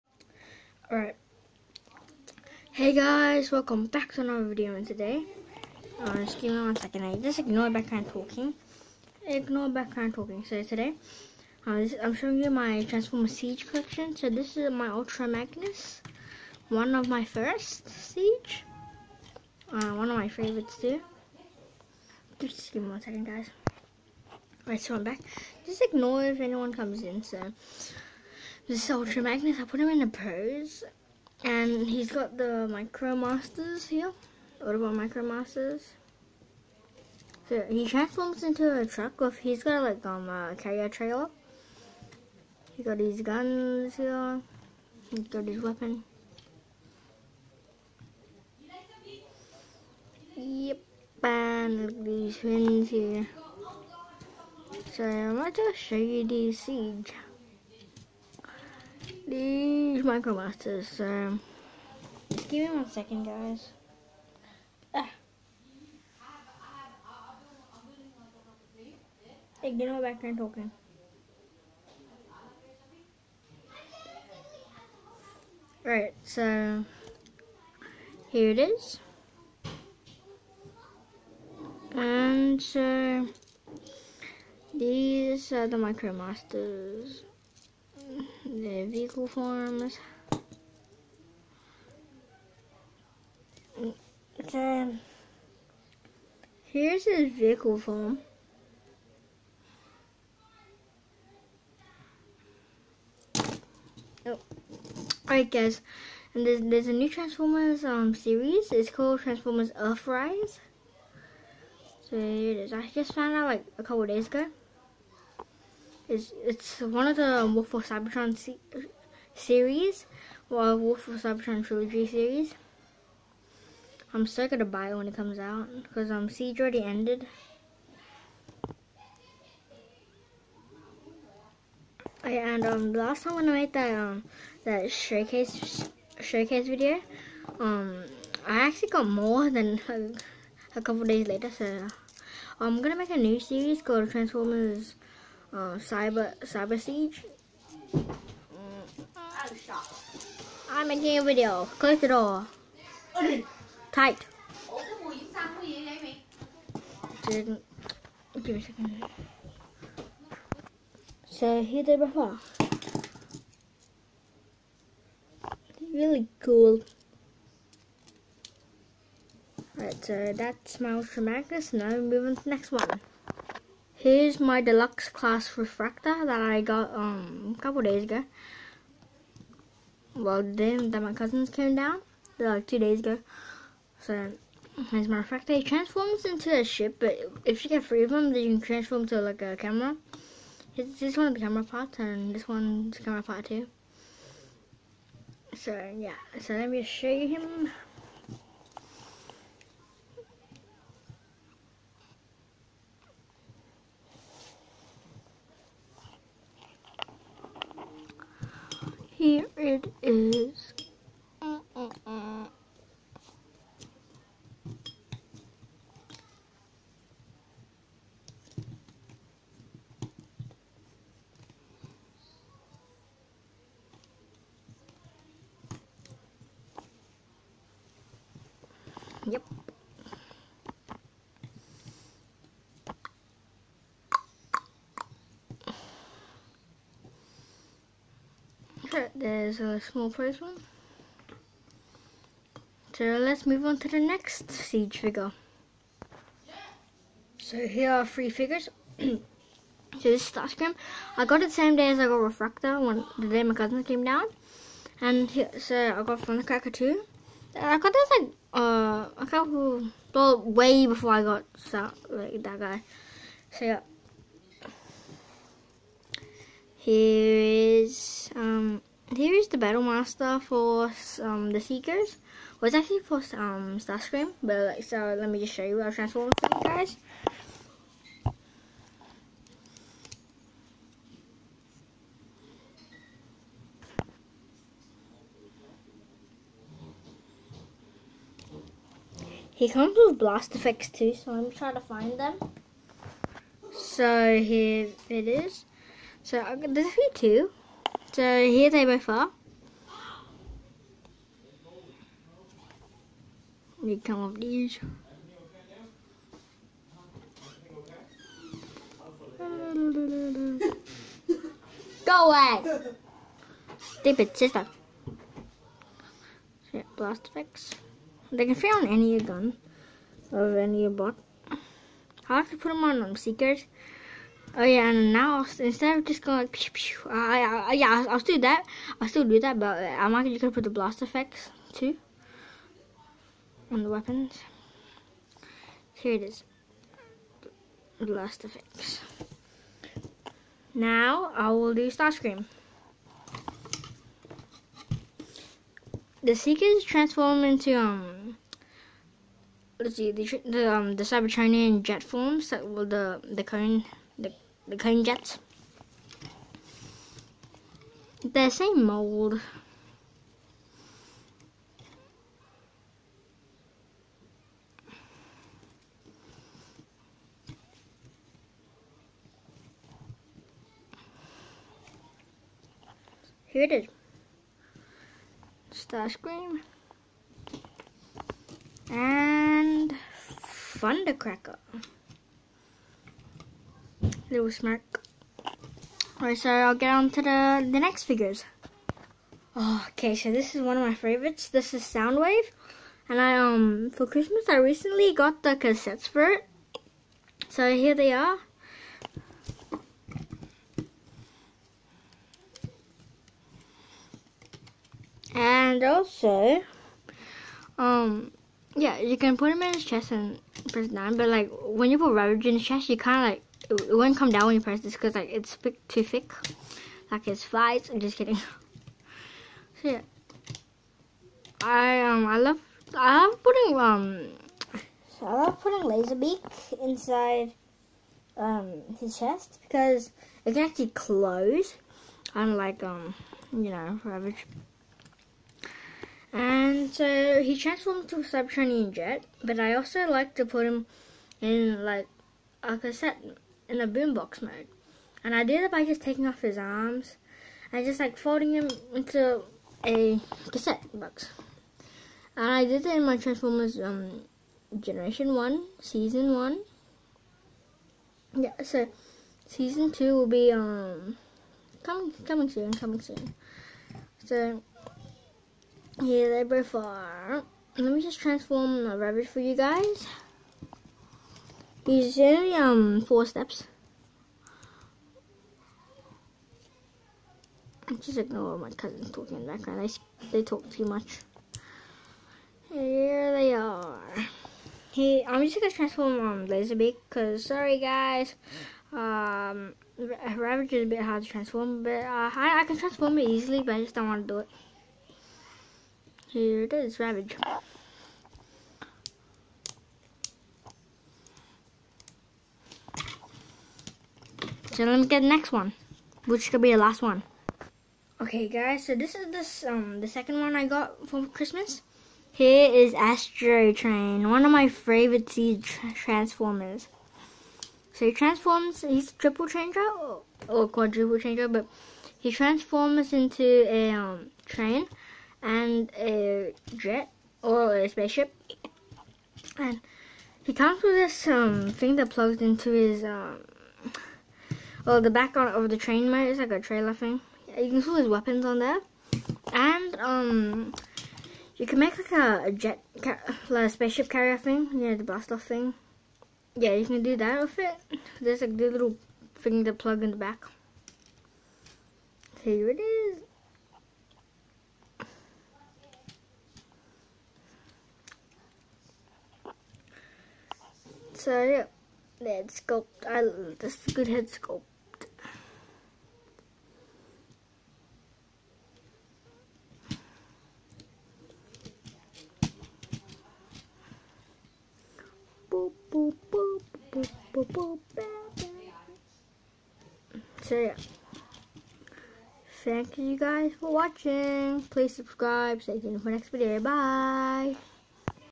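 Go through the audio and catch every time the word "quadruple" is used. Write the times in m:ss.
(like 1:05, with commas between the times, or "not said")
8:40.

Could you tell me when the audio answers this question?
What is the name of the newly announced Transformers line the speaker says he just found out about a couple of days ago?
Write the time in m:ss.
1:49.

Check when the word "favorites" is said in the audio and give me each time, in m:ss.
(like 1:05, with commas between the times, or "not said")
0:20, 6:30, 8:34.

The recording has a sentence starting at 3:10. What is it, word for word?
Here's this one of the camera parts, and this one's camera part too.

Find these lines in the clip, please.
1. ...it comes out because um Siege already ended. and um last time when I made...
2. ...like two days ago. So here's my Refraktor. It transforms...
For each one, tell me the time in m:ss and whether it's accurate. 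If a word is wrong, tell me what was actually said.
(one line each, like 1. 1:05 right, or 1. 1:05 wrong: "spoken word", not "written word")
1. 2:05 right
2. 3:02 right.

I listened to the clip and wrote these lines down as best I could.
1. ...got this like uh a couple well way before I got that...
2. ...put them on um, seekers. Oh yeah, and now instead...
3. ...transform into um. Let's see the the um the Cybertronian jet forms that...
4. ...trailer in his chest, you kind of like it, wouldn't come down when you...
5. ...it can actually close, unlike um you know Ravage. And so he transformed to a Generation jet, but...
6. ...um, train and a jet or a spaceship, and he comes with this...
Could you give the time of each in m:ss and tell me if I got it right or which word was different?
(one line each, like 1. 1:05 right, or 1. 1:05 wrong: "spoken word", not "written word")
1. 4:17 right
2. 5:22 right
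3. 5:46 right
4. 6:52 wrong: "rubber", not "trailer"
5. 7:10 wrong: "Cybertronian", not "Generation"
6. 8:43 right.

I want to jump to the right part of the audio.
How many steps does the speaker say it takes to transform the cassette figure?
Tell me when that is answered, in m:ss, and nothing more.
7:53.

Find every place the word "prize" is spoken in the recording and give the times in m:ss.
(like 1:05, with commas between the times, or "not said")
4:00.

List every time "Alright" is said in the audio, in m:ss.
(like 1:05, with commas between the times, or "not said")
0:00, 0:24, 1:45, 2:49, 6:26.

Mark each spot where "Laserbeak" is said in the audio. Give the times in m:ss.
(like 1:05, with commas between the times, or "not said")
7:05, 8:06.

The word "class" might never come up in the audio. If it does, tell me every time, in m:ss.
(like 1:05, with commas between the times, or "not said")
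2:55.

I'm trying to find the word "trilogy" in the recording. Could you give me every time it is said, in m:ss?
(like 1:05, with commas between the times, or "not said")
2:01.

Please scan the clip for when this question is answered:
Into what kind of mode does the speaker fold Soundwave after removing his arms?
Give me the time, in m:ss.
7:23.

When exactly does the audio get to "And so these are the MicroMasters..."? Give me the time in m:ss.
1:21.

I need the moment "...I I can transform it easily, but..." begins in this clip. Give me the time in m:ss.
8:12.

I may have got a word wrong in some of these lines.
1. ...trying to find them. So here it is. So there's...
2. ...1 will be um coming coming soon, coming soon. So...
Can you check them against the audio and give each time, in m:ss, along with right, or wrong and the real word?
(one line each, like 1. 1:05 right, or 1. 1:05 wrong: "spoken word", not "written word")
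1. 4:51 right
2. 7:39 wrong: "2", not "1".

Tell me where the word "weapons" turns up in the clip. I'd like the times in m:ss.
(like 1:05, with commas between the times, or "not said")
0:45, 5:33, 8:58.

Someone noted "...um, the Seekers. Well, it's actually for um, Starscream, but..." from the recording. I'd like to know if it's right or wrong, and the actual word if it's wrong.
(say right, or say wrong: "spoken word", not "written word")
right.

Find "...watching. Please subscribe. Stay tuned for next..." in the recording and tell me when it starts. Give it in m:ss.
9:43.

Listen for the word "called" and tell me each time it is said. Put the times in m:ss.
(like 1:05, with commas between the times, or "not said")
1:48, 2:23.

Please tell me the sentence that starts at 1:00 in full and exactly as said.
So give me one second, guys.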